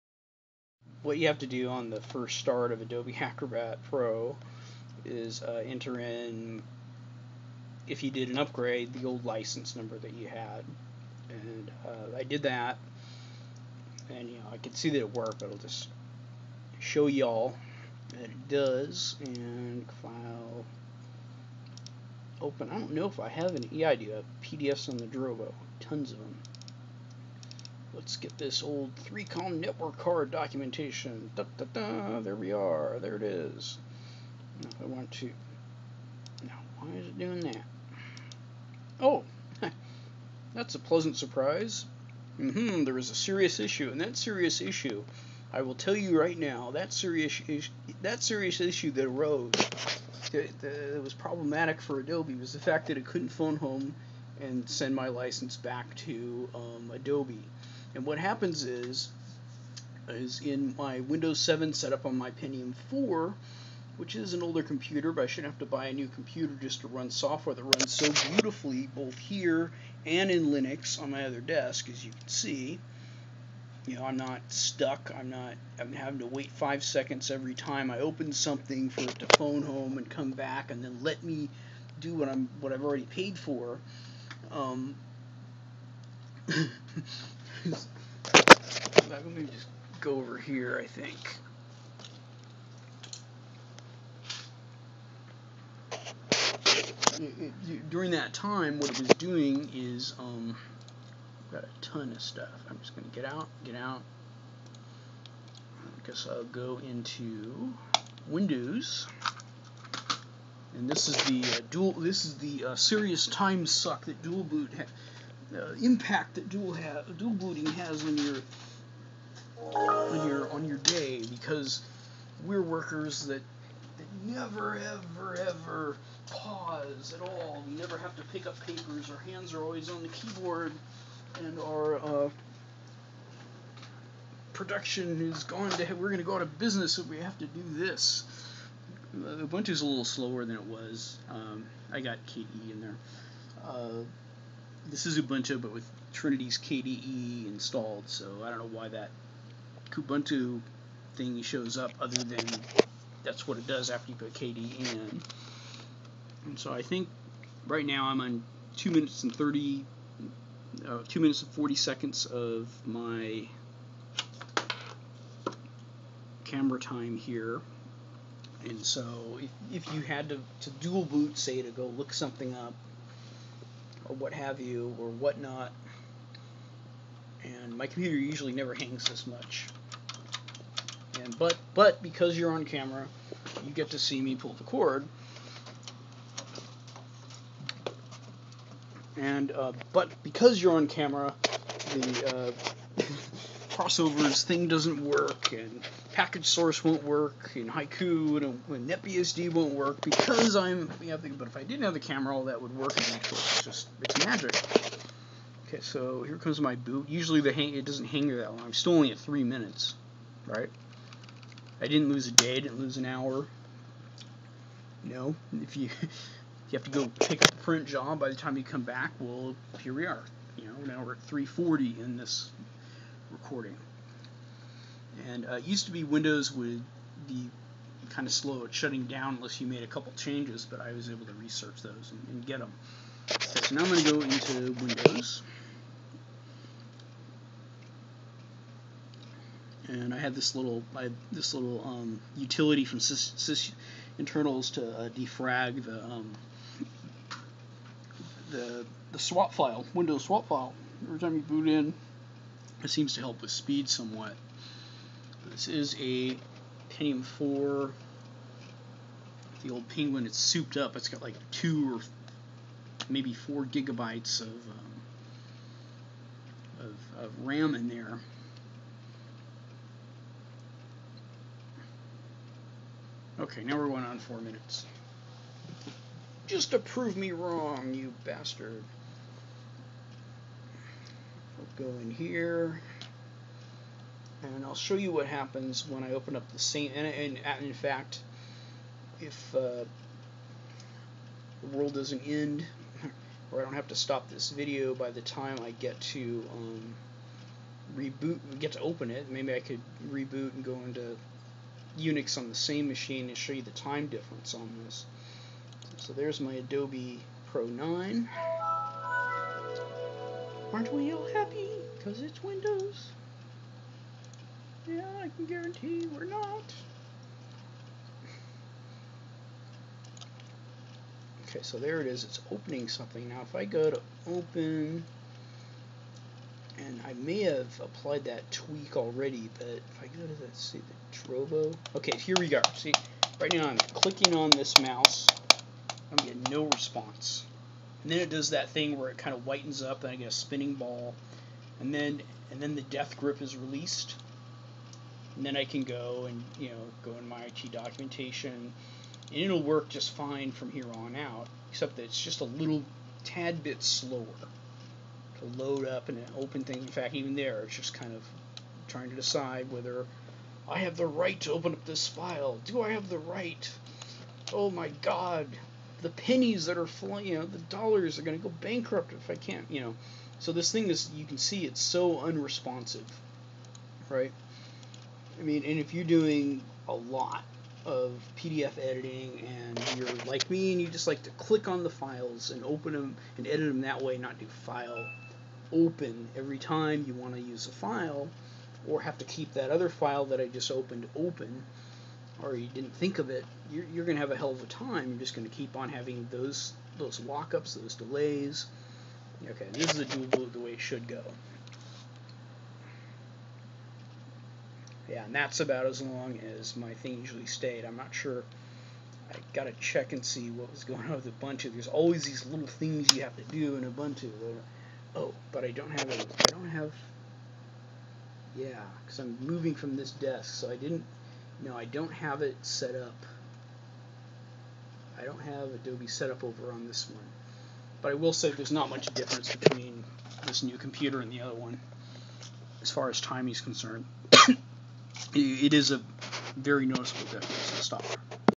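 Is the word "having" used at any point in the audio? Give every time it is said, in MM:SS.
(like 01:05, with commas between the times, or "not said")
01:15, 06:35.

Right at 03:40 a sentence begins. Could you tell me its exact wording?
You know, now we're at 340 in this recording.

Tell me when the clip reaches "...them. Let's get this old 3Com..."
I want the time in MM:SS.
00:26.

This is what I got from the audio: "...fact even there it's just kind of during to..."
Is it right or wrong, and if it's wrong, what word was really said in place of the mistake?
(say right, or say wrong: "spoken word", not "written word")
wrong: "trying", not "during".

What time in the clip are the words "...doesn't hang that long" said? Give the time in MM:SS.
03:27.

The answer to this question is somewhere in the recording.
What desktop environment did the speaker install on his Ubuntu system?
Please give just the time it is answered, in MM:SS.
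02:26.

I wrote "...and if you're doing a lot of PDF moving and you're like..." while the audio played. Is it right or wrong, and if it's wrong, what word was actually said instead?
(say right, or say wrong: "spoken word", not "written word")
wrong: "editing", not "moving".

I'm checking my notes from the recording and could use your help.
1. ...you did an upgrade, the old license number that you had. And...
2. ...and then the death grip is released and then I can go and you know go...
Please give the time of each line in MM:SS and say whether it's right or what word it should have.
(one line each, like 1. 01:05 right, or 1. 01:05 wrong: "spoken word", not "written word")
1. 00:08 right
2. 05:42 right.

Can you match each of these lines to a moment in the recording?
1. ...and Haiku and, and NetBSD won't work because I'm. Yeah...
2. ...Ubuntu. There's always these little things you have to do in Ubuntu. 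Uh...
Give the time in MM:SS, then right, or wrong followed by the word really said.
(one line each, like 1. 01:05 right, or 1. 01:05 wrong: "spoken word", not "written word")
1. 03:17 right
2. 06:51 right.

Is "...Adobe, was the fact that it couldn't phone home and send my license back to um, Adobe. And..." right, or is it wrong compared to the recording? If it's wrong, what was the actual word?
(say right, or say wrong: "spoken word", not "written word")
right.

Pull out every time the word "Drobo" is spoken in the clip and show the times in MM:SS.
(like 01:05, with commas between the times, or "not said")
00:25, 05:31.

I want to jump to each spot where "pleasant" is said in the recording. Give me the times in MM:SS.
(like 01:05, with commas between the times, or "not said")
00:40.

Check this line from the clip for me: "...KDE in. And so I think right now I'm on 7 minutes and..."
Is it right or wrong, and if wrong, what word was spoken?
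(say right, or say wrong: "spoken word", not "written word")
wrong: "2", not "7".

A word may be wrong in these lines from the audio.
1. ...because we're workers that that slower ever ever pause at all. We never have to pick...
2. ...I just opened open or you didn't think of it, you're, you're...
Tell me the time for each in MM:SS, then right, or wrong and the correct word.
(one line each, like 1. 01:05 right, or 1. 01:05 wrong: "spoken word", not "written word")
1. 02:01 wrong: "never", not "slower"
2. 06:30 right.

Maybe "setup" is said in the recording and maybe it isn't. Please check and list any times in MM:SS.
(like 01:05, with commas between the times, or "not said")
01:01.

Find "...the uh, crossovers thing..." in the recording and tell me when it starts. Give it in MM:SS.
03:11.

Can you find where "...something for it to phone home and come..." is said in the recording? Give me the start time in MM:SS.
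01:18.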